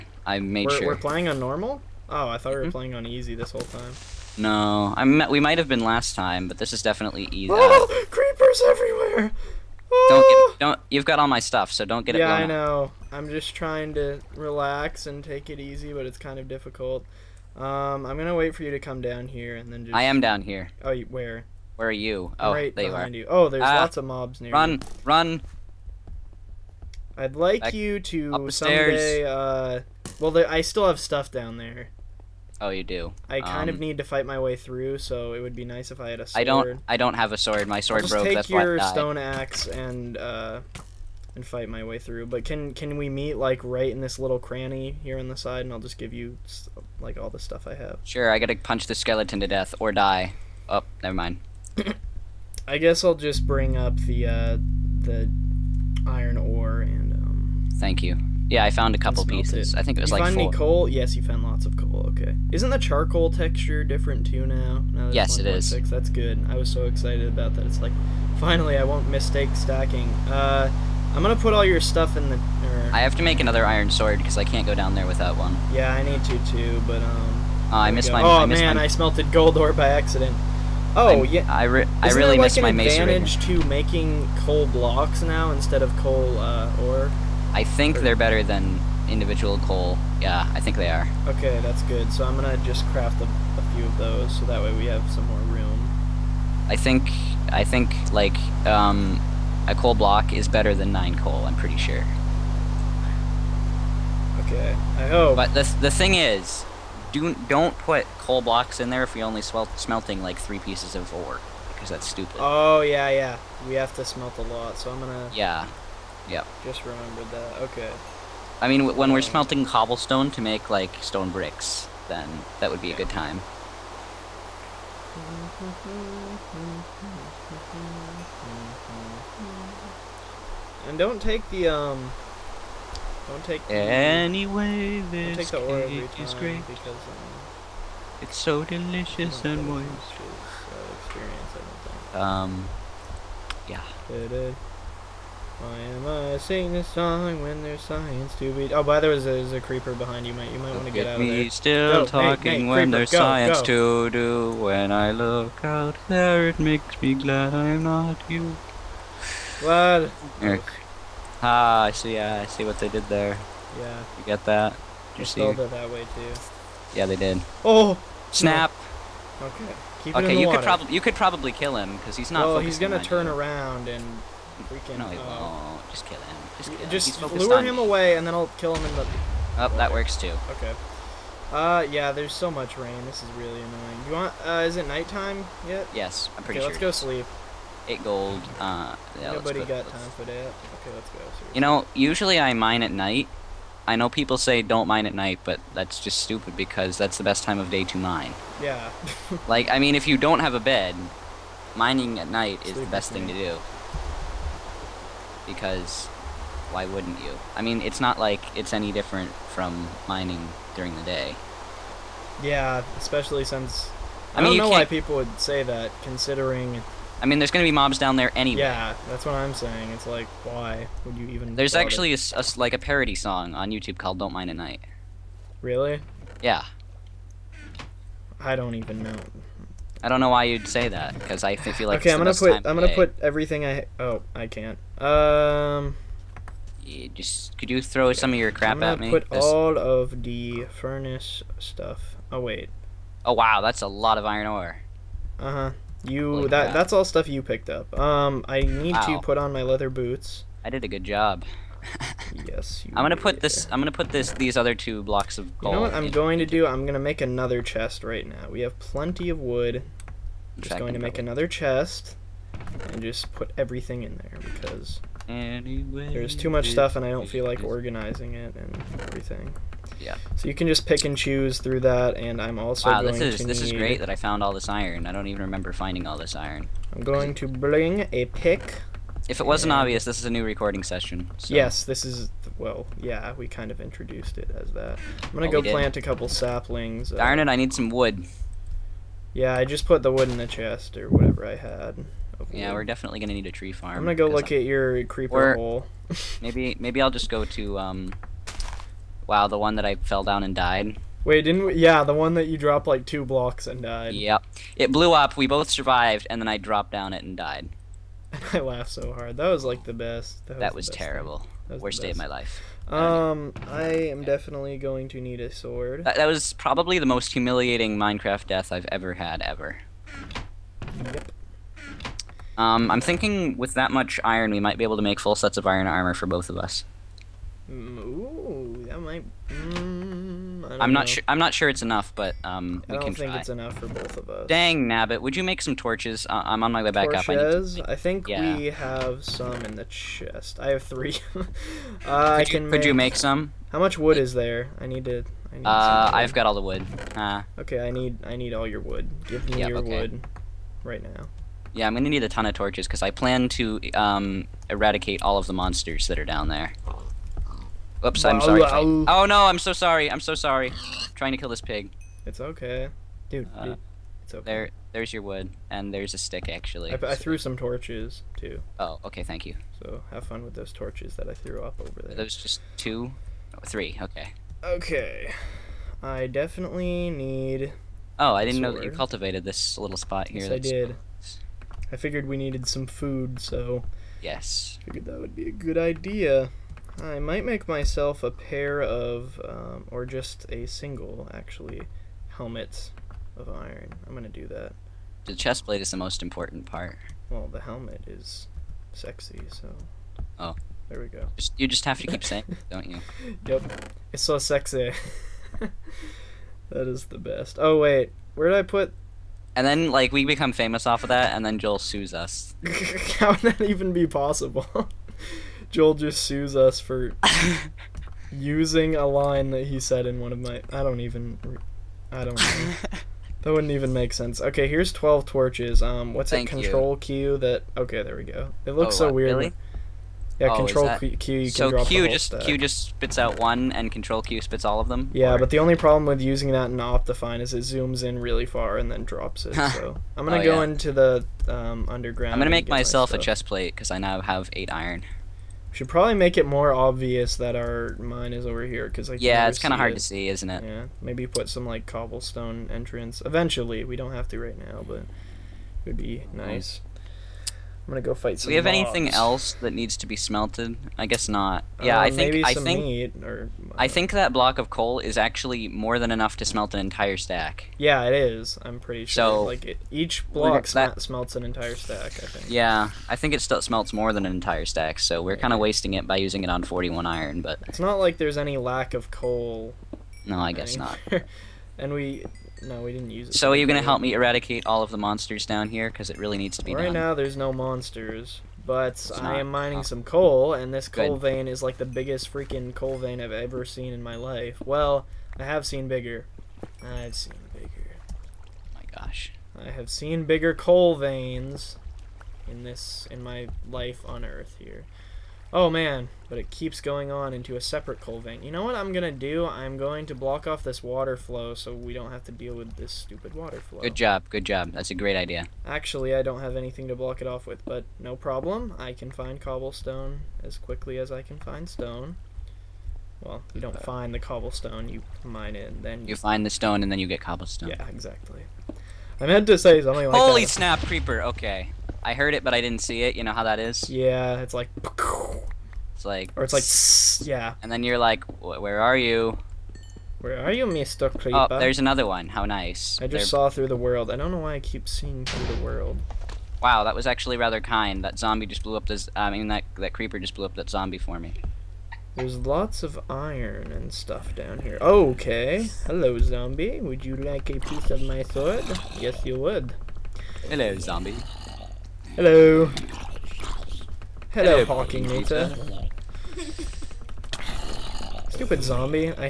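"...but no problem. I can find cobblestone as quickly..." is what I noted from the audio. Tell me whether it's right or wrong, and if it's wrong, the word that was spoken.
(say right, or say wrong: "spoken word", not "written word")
right.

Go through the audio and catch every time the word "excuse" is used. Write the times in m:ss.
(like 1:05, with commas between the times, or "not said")
not said.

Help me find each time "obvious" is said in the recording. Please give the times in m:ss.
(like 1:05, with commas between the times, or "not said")
4:39, 7:26.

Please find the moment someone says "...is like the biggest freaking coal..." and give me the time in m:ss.
8:11.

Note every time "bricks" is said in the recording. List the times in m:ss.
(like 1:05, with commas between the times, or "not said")
2:01.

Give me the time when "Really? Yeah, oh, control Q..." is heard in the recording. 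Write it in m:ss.
7:09.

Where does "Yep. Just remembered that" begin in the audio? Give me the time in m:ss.
1:56.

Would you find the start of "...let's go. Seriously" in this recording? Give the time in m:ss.
3:10.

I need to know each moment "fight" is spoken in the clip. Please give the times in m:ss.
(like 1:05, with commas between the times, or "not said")
0:34, 0:41, 7:38.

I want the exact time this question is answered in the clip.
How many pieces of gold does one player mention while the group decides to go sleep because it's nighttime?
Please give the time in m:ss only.
3:07.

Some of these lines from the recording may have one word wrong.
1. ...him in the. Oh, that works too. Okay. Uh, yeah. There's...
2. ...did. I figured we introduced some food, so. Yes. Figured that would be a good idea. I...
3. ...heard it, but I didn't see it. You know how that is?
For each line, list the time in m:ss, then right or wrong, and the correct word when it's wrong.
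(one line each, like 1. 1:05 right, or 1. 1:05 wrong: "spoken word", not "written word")
1. 2:58 right
2. 6:20 wrong: "needed", not "introduced"
3. 8:52 right.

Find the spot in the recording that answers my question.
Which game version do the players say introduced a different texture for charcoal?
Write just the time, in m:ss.
1:05.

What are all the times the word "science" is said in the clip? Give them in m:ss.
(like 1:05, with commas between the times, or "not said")
2:27, 2:33.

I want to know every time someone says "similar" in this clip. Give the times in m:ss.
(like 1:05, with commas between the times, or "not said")
not said.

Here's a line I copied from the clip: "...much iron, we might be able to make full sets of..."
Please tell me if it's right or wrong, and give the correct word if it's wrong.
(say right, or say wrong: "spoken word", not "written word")
right.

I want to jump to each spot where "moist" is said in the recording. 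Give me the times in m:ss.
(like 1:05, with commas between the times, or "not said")
2:19.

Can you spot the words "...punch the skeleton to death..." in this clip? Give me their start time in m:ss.
0:48.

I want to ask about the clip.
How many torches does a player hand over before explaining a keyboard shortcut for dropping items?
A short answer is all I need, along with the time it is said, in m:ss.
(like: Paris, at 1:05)
12, at 7:04.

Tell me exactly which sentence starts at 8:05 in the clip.
Because it really needs to be right done.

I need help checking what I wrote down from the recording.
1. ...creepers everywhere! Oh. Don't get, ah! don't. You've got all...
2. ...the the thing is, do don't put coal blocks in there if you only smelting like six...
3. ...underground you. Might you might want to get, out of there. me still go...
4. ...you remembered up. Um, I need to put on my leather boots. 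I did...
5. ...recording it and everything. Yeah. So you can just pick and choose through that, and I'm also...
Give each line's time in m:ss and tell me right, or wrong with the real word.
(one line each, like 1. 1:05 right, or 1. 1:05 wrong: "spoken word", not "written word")
1. 0:08 right
2. 1:45 wrong: "three", not "six"
3. 2:29 wrong: "behind", not "underground"
4. 4:07 wrong: "picked", not "remembered"
5. 4:27 wrong: "organizing", not "recording".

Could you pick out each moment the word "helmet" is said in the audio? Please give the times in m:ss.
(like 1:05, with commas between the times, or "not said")
6:32, 6:37.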